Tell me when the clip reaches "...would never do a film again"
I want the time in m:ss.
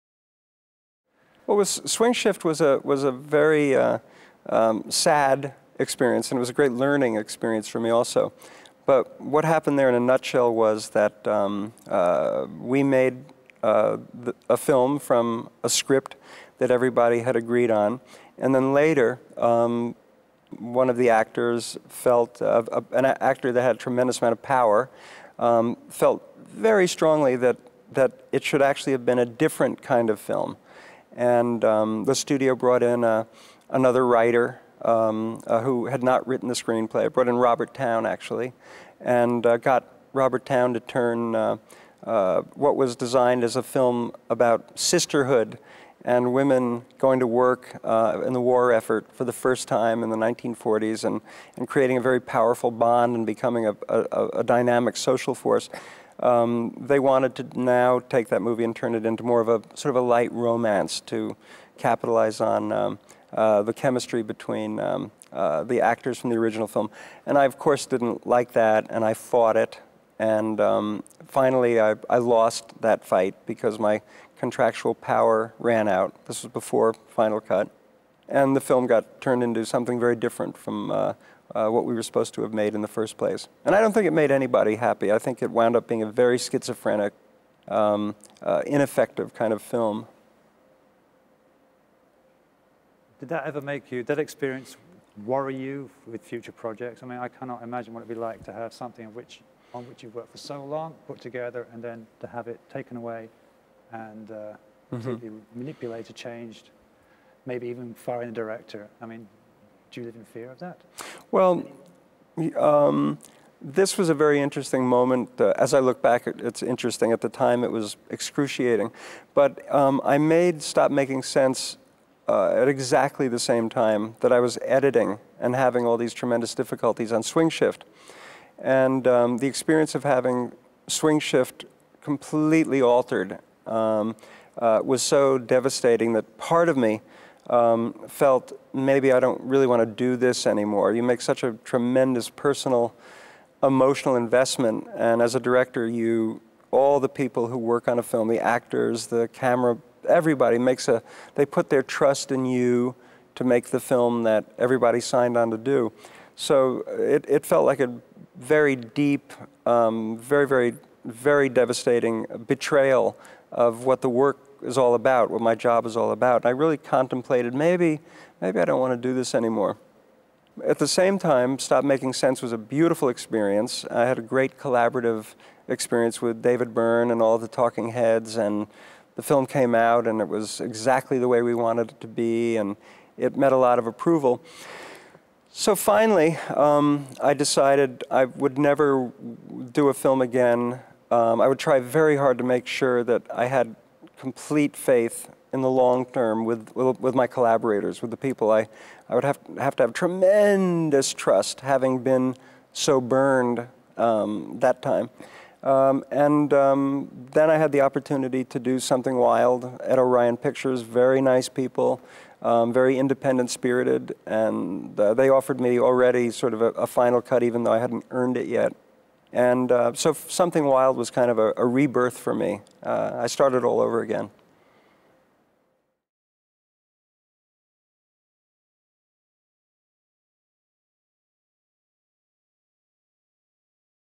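3:08.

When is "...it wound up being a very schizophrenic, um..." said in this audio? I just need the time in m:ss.
1:25.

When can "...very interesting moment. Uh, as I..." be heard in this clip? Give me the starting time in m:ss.
1:54.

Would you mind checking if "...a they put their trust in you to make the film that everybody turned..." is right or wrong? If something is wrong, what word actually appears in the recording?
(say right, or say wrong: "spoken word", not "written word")
wrong: "signed", not "turned".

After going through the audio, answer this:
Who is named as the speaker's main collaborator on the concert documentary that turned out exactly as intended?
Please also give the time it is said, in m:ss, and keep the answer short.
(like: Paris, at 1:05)
David Byrne, at 2:56.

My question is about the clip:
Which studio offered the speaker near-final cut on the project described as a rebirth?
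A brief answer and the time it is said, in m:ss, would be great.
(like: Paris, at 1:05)
Orion Pictures, at 3:29.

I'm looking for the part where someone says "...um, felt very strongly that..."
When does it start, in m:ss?
0:25.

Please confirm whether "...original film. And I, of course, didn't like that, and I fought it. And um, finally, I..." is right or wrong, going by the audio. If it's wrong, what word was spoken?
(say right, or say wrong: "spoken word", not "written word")
right.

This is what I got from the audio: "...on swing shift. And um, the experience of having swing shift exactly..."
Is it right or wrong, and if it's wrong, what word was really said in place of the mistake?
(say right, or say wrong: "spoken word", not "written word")
wrong: "completely", not "exactly".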